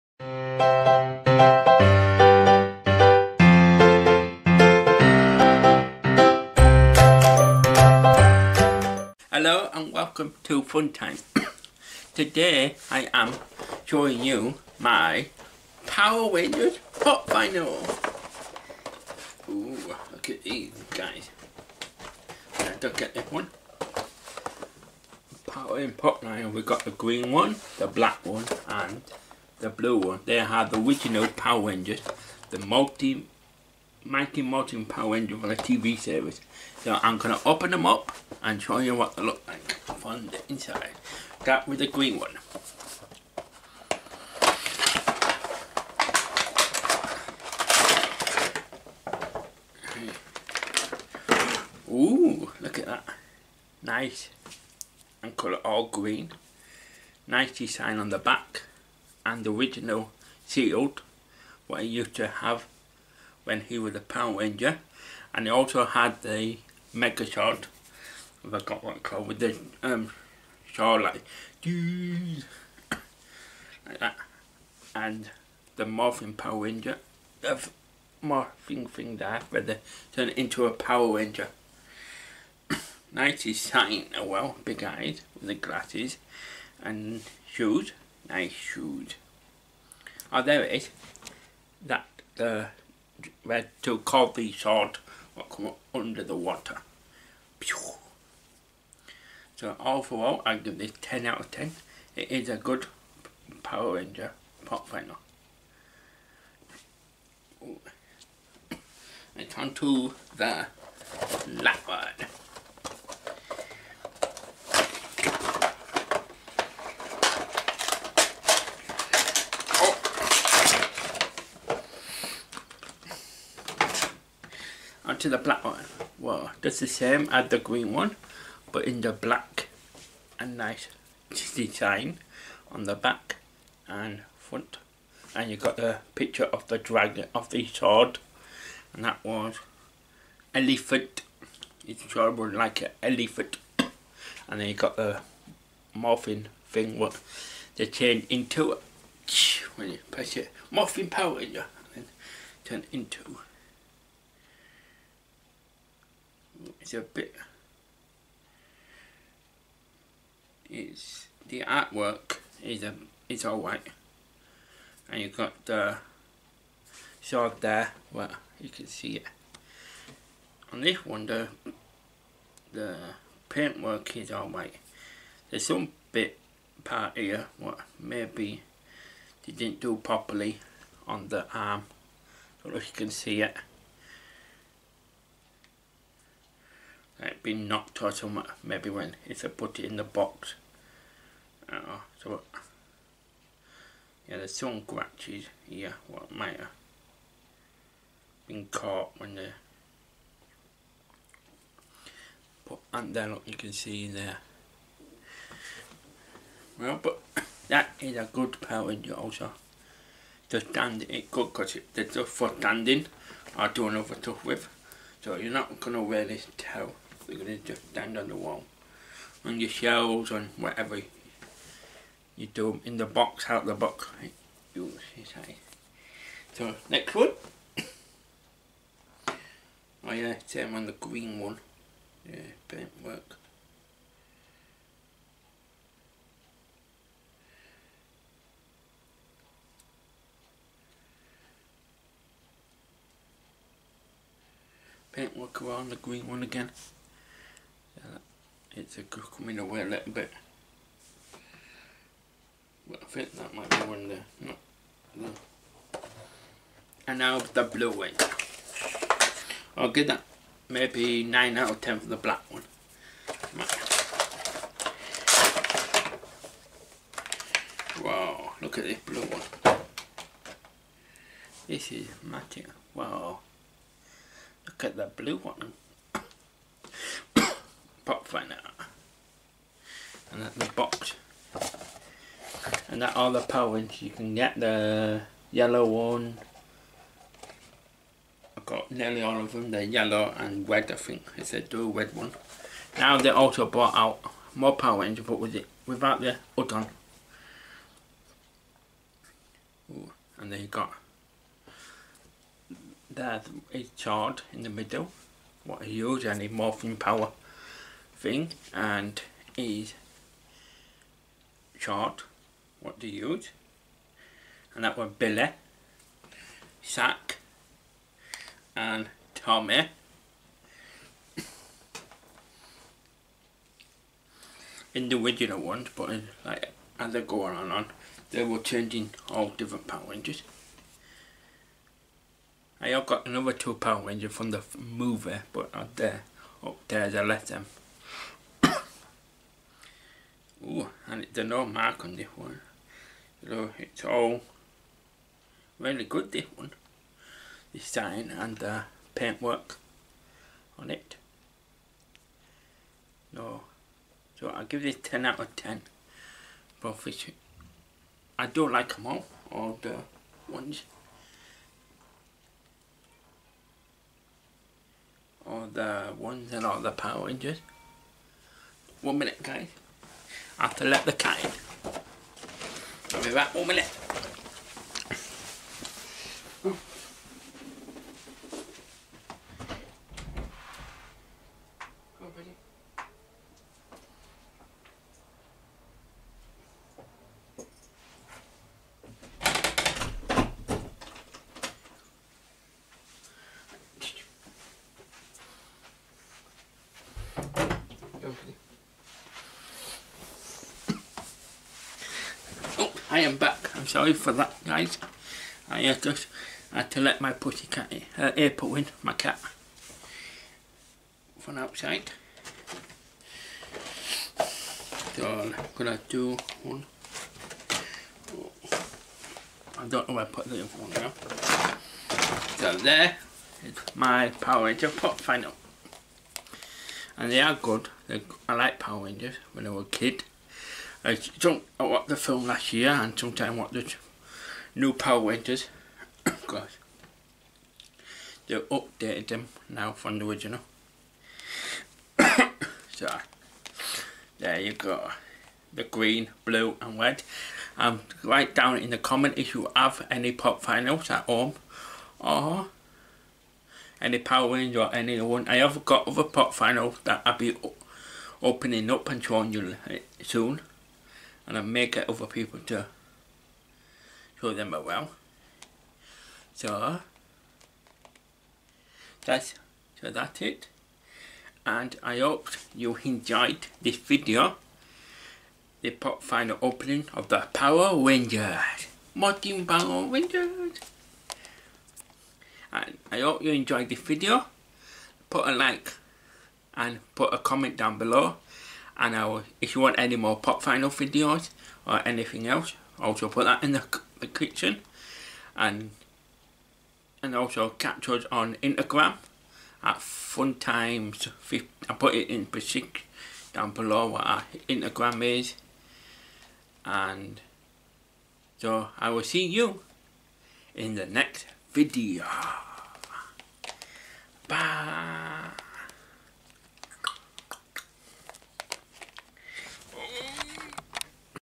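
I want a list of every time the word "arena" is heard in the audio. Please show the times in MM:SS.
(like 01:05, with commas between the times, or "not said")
not said.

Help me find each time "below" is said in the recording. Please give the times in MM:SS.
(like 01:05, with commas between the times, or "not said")
08:07, 08:23.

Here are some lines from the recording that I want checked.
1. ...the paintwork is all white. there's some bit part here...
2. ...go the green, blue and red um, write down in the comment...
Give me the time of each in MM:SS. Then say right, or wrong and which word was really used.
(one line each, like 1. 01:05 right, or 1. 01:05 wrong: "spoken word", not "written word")
1. 02:52 right
2. 07:24 right.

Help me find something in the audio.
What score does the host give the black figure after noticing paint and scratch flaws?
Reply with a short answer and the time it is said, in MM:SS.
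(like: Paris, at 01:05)
9 out of 10, at 04:20.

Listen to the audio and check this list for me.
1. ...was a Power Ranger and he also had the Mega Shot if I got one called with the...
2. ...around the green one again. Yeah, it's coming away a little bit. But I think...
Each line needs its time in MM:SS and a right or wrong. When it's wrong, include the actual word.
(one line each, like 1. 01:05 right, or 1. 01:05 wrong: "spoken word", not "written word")
1. 01:03 right
2. 04:05 right.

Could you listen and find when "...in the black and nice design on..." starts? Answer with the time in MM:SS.
02:08.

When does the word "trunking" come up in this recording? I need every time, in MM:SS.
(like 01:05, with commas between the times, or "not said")
not said.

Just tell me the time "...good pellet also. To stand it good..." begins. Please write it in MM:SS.
03:28.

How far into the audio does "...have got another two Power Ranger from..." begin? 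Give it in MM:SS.
05:32.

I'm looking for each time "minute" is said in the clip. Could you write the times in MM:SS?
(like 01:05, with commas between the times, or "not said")
06:09, 06:13.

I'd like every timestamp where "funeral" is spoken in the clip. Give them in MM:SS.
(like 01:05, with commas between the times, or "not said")
not said.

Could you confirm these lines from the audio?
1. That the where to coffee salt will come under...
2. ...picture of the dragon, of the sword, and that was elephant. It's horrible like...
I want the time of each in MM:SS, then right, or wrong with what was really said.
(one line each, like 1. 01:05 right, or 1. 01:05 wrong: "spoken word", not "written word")
1. 01:31 right
2. 02:16 right.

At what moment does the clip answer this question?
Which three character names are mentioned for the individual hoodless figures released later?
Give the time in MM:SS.
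05:15.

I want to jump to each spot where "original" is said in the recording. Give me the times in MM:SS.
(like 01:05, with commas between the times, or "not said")
00:30, 00:59, 07:20.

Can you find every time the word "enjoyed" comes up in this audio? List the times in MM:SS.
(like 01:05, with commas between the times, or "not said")
07:53, 08:03.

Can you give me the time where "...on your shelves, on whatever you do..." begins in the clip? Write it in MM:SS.
03:39.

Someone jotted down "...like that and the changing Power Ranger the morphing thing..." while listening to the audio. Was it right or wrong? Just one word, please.
wrong.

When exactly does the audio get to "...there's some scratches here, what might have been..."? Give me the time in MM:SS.
03:14.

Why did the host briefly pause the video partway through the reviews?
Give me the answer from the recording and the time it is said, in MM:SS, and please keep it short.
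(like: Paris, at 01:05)
to let the cat in, at 06:10.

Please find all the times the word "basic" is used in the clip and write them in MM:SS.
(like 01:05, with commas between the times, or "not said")
08:22.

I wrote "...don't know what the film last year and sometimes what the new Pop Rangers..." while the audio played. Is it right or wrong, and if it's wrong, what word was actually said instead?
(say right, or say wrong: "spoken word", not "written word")
wrong: "Power", not "Pop".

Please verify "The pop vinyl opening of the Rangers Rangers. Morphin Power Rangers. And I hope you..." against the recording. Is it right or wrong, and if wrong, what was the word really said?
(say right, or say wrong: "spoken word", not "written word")
wrong: "Power", not "Rangers".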